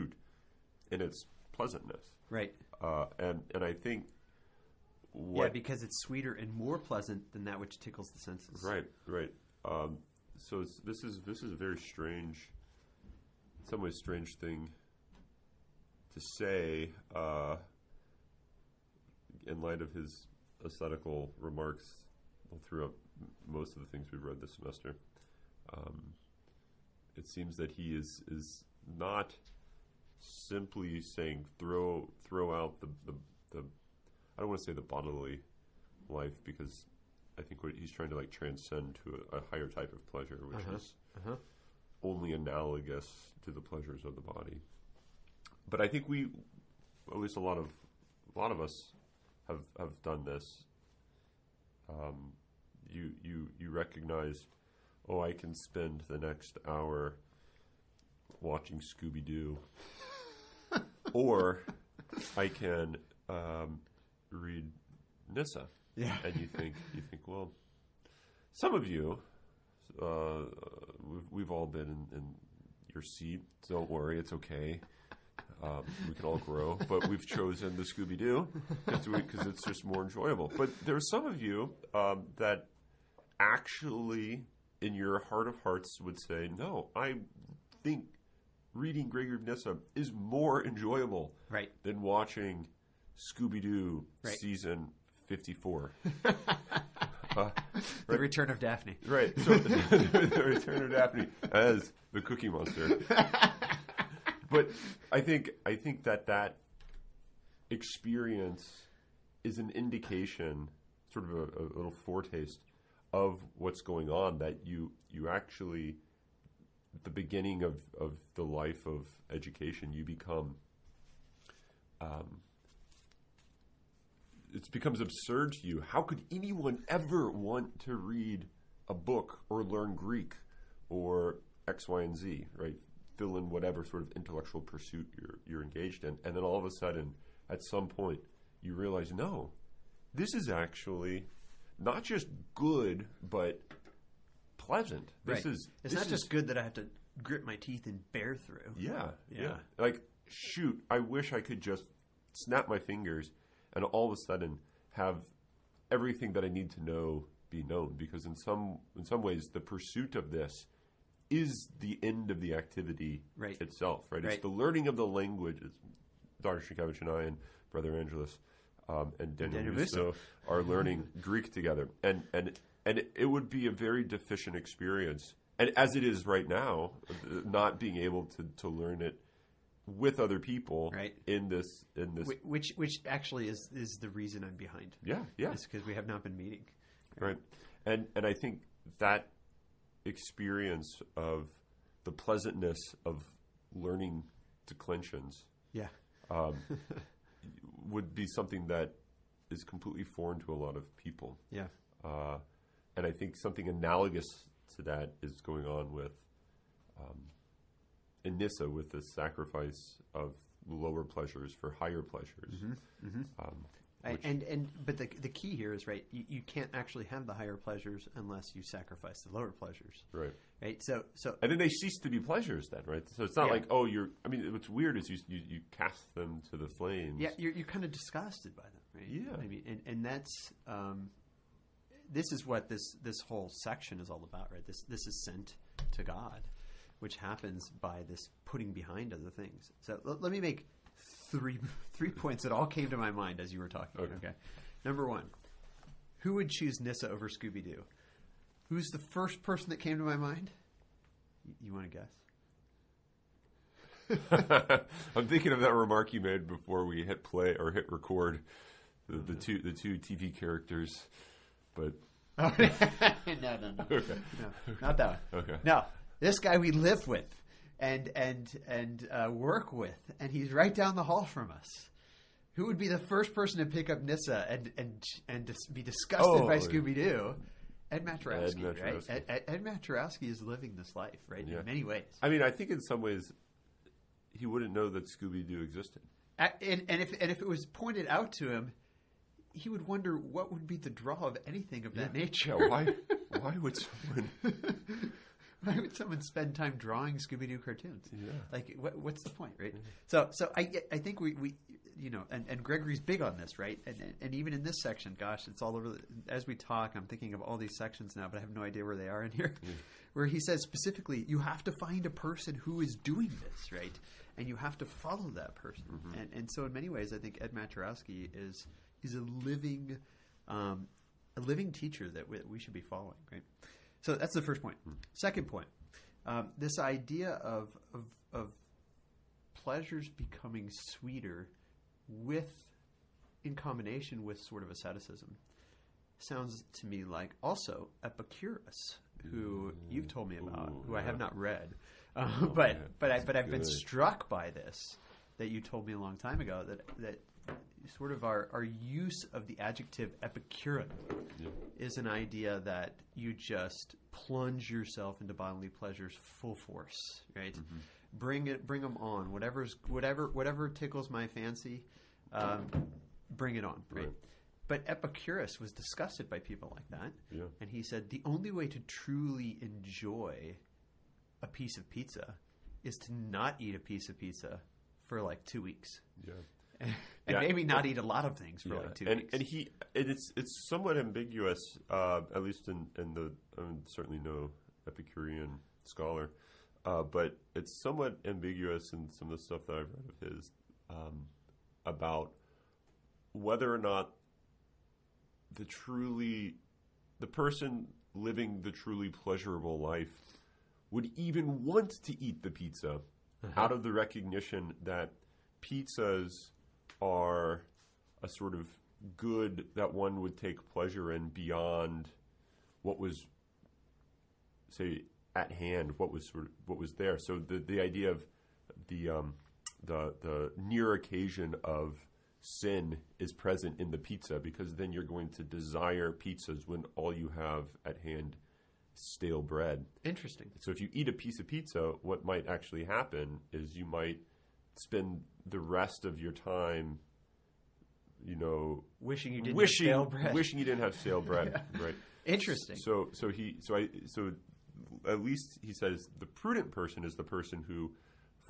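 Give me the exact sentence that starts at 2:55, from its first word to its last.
And as it is right now, not being able to, to learn it with other people right.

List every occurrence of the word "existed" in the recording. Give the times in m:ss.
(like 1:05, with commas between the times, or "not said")
4:45.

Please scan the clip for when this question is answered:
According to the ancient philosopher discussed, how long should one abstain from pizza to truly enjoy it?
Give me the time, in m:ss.
6:15.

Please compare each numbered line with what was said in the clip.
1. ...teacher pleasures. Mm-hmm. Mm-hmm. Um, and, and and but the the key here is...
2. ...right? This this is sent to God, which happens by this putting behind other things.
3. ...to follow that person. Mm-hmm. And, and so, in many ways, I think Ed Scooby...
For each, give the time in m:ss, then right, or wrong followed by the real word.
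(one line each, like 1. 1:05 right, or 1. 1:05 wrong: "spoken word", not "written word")
1. 3:31 wrong: "higher", not "teacher"
2. 3:54 right
3. 5:14 wrong: "Maturowski", not "Scooby".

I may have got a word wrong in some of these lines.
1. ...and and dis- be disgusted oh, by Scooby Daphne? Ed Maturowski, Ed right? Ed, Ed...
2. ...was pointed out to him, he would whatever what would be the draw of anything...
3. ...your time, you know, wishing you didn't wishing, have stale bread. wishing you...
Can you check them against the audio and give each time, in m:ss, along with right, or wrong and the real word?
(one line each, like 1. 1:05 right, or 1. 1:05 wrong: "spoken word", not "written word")
1. 4:34 wrong: "Doo", not "Daphne"
2. 4:47 wrong: "wonder", not "whatever"
3. 7:16 right.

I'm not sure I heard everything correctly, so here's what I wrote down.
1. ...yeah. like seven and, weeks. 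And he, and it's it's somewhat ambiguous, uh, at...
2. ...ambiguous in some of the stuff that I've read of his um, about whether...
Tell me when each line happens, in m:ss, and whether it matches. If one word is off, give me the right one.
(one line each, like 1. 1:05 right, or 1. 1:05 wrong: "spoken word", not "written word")
1. 6:18 wrong: "two", not "seven"
2. 6:28 right.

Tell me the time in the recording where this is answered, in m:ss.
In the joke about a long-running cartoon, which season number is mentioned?
1:34.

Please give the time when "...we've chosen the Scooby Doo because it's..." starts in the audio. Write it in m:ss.
1:17.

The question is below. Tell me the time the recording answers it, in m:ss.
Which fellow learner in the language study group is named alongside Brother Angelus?
2:49.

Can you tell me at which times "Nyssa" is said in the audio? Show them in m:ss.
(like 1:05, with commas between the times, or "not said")
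1:05, 1:29, 4:06, 4:34.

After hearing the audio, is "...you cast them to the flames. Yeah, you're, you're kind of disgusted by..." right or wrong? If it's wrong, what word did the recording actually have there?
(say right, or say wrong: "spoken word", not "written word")
right.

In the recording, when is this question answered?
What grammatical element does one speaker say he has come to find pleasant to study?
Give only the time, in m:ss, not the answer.
3:14.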